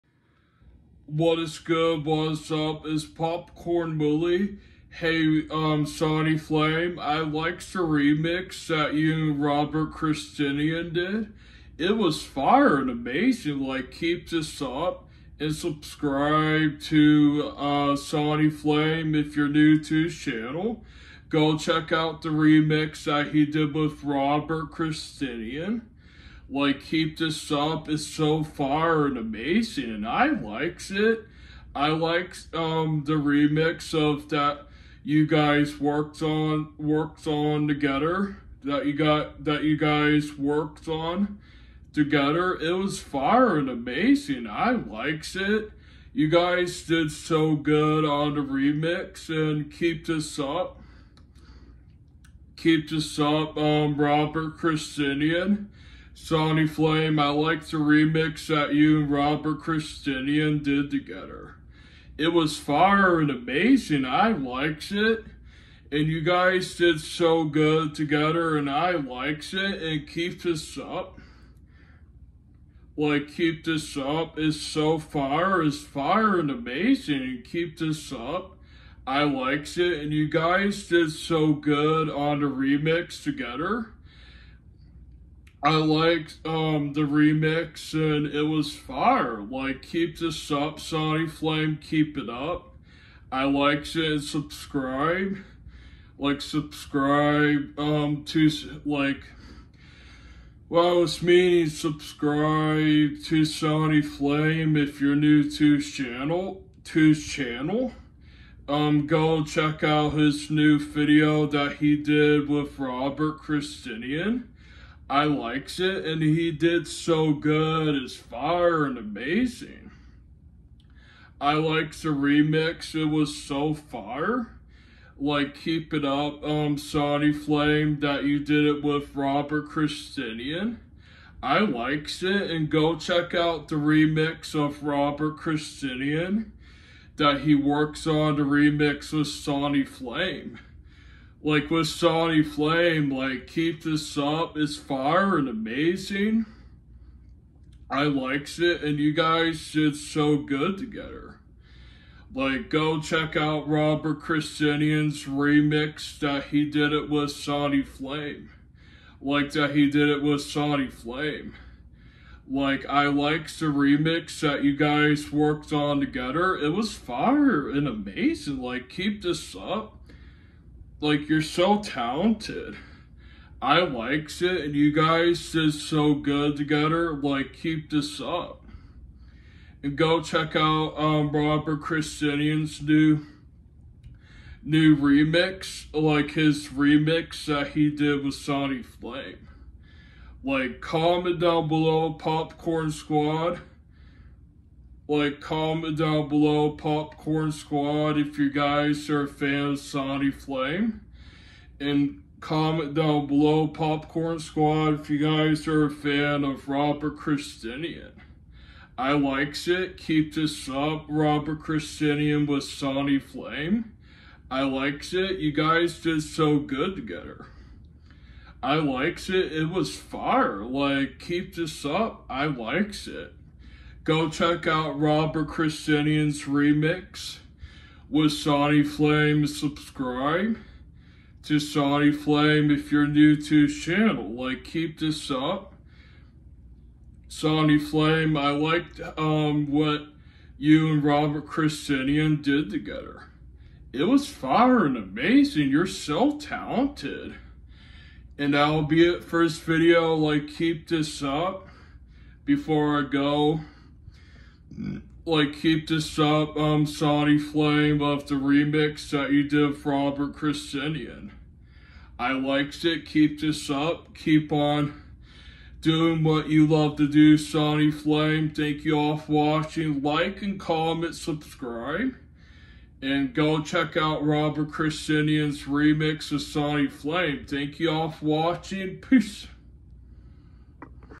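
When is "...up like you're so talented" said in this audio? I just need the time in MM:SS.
02:49.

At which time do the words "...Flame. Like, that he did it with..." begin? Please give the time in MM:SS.
02:37.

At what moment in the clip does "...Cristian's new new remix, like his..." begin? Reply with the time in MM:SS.
03:01.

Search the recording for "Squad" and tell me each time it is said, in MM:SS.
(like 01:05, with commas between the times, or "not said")
03:12, 03:17, 03:24.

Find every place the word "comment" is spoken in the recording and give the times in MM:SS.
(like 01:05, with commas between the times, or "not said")
03:10, 03:15, 03:22, 04:30.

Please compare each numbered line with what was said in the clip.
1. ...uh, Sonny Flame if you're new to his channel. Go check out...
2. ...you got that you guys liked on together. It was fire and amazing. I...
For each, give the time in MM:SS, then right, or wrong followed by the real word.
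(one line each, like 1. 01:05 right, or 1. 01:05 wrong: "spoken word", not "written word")
1. 00:17 right
2. 00:38 wrong: "worked", not "liked".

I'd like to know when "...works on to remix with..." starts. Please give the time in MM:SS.
02:17.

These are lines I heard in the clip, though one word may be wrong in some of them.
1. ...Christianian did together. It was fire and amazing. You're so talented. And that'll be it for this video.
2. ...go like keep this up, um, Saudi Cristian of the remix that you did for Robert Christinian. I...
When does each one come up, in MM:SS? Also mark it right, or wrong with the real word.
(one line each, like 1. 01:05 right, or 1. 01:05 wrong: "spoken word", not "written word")
1. 04:01 right
2. 04:13 wrong: "Flame", not "Cristian".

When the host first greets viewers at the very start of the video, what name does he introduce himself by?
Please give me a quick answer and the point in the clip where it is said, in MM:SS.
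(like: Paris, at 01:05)
Popcorn Willy, at 00:03.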